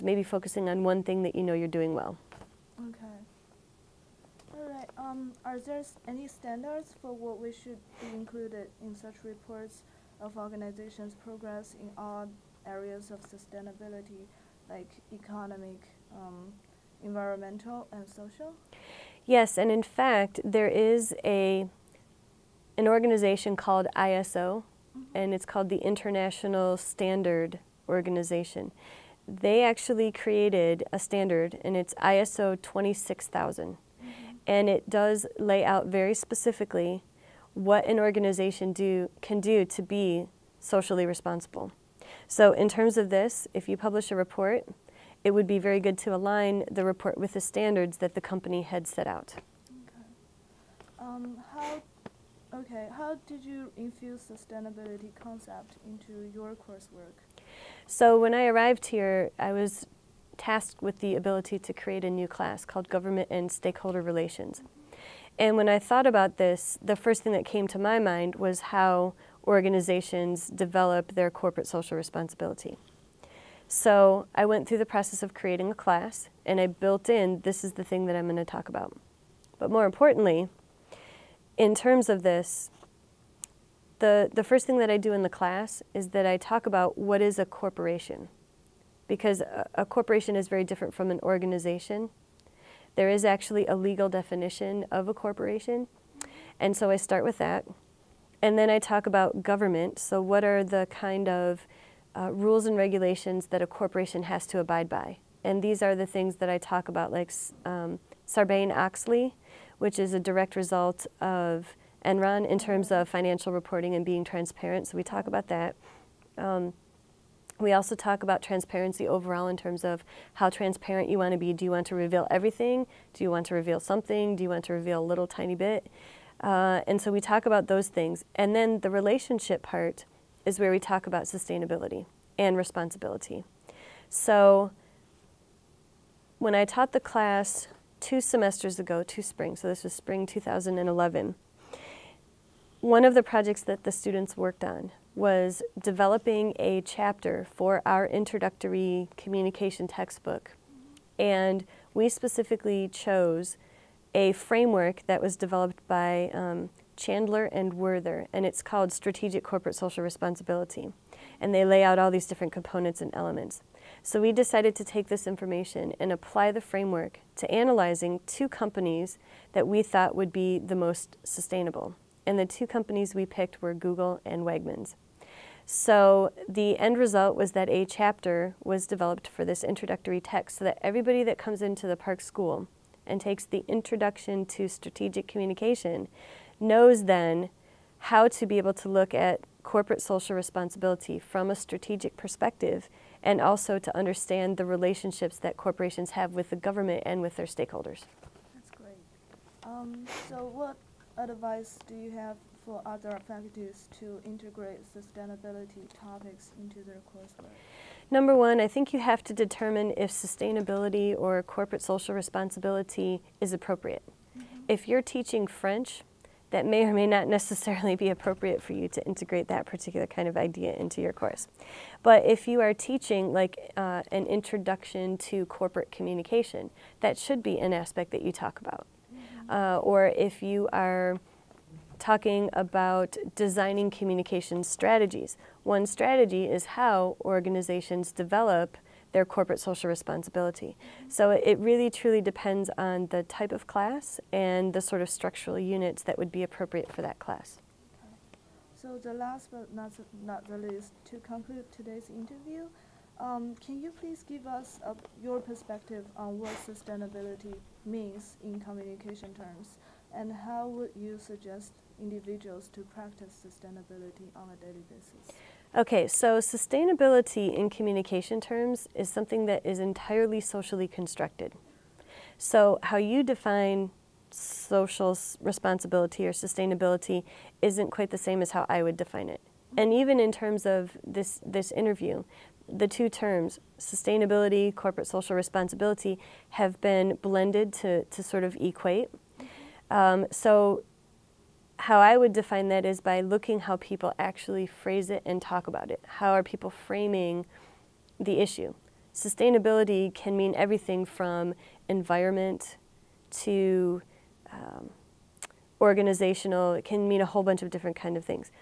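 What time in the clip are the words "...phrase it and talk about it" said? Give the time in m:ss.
4:54.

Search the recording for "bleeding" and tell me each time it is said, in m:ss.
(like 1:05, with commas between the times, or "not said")
not said.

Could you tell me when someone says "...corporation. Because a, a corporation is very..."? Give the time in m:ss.
1:27.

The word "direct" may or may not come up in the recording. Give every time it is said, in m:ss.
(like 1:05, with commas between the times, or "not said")
1:50.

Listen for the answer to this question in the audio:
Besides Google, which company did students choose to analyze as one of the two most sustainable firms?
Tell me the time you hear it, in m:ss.
2:54.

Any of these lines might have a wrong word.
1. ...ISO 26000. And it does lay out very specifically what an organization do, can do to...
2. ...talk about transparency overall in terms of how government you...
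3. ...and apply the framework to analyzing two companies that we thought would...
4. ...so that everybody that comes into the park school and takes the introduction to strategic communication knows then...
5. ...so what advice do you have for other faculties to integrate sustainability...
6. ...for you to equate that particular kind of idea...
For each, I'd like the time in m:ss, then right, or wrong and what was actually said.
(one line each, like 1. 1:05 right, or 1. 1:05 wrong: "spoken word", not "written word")
1. 0:31 right
2. 1:57 wrong: "transparent", not "government"
3. 2:45 right
4. 3:00 right
5. 3:20 right
6. 3:38 wrong: "integrate", not "equate".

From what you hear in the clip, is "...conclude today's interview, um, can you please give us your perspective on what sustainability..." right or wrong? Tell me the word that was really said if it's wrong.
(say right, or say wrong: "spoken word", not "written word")
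right.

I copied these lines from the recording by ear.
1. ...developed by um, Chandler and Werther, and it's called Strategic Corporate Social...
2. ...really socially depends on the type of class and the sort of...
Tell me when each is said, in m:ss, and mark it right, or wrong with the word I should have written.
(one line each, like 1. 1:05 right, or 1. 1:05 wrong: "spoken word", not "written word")
1. 2:35 right
2. 4:01 wrong: "truly", not "socially".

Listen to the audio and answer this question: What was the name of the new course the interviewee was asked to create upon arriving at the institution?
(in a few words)
Government and Stakeholder Relations.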